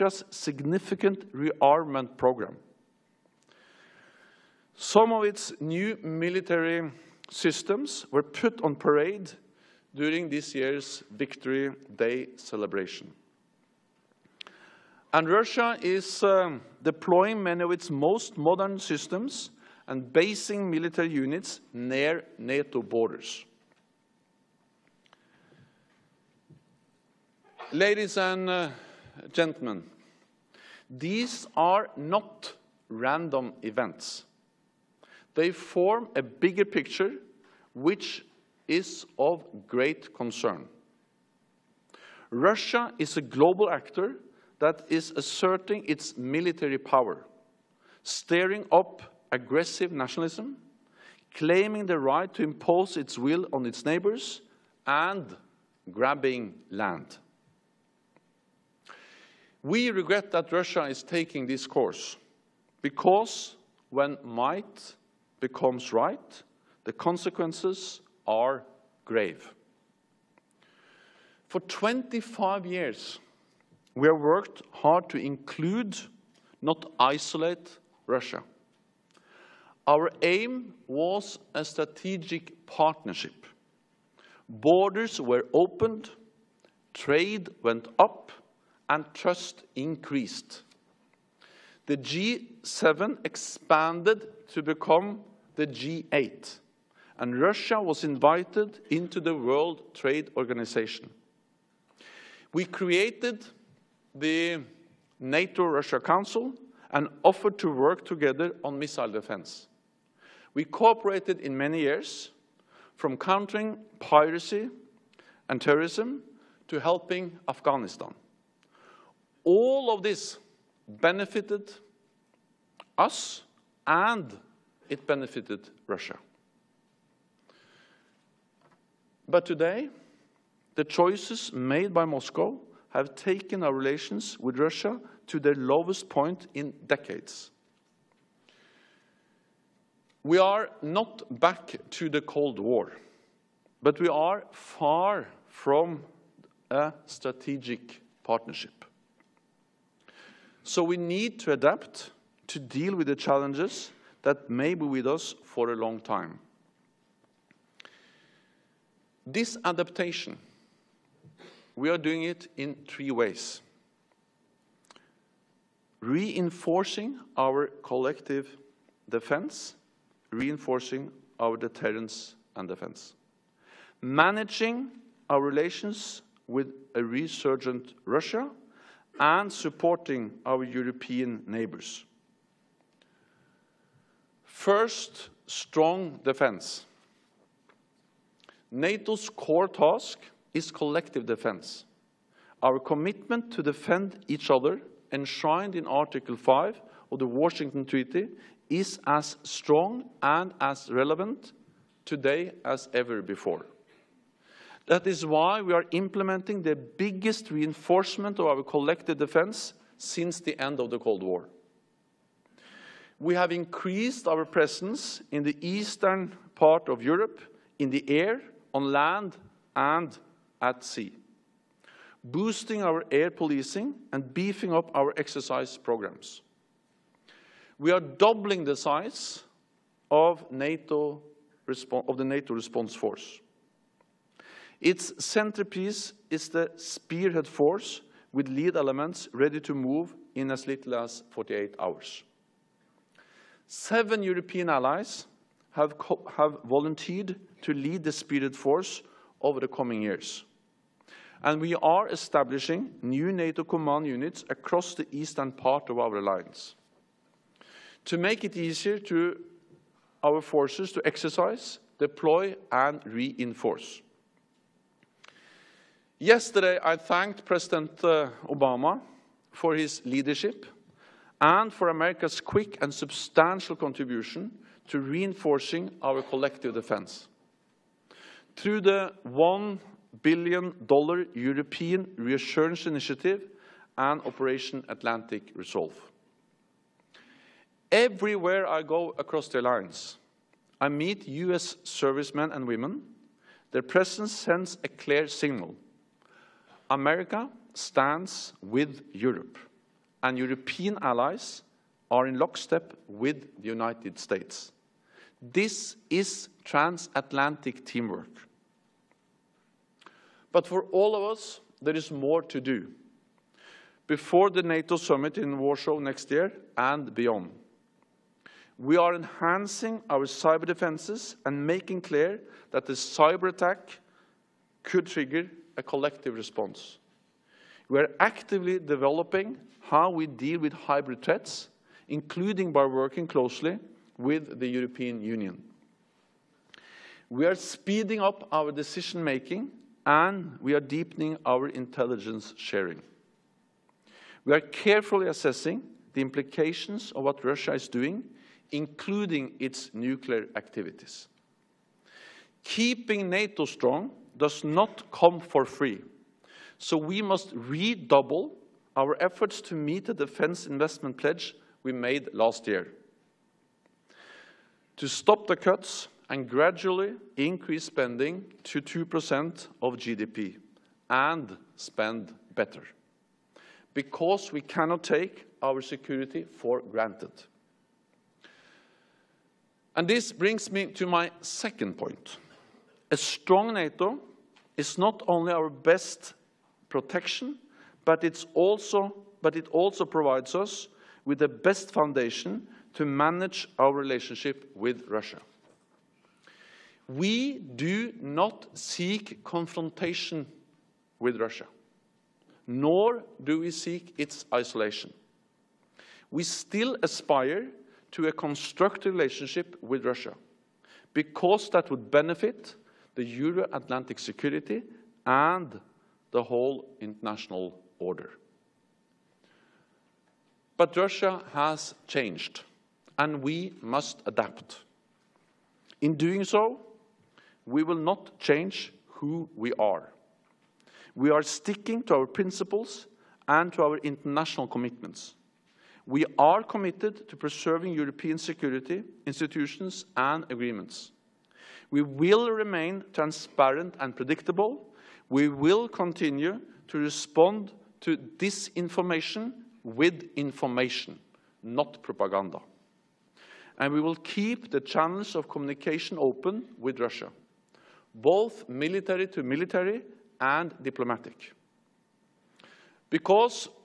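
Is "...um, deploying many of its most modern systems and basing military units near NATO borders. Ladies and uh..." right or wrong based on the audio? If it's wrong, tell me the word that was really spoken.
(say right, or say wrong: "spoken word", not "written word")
right.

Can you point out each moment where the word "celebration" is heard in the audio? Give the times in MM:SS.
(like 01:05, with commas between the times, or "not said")
00:12.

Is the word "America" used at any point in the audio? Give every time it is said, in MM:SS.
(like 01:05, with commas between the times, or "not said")
04:31, 04:56.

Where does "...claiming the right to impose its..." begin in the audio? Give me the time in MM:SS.
00:51.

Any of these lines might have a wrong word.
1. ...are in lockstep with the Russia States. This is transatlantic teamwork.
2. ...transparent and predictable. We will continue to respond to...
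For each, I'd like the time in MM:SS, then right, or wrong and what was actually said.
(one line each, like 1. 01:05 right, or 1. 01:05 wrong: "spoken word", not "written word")
1. 05:02 wrong: "United", not "Russia"
2. 07:23 right.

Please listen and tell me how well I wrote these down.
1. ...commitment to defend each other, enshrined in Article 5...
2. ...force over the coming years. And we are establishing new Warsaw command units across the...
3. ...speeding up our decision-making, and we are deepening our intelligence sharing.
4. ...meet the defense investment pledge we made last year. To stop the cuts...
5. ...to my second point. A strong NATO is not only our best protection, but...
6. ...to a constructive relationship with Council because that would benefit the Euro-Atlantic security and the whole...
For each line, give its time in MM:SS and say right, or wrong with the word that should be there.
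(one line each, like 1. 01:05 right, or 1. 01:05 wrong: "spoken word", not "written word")
1. 03:12 right
2. 04:08 wrong: "NATO", not "Warsaw"
3. 05:37 right
4. 05:59 right
5. 06:20 right
6. 06:48 wrong: "Russia", not "Council".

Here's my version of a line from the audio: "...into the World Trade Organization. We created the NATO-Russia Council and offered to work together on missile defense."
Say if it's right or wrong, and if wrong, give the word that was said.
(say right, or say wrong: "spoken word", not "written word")
right.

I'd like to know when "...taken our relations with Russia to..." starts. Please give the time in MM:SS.
02:13.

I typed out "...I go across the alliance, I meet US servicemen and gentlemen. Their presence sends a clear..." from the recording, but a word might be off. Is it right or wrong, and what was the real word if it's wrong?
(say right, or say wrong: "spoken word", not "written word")
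wrong: "women", not "gentlemen".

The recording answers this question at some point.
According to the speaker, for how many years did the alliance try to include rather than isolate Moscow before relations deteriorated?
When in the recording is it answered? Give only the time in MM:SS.
01:11.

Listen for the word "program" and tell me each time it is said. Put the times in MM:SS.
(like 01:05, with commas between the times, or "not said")
00:02, 03:45.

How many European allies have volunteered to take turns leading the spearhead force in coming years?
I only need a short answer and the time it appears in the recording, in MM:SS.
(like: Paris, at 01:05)
7, at 04:03.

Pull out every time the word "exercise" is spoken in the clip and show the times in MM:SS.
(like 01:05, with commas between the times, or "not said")
03:45, 04:21.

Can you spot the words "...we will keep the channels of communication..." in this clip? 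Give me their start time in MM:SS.
07:33.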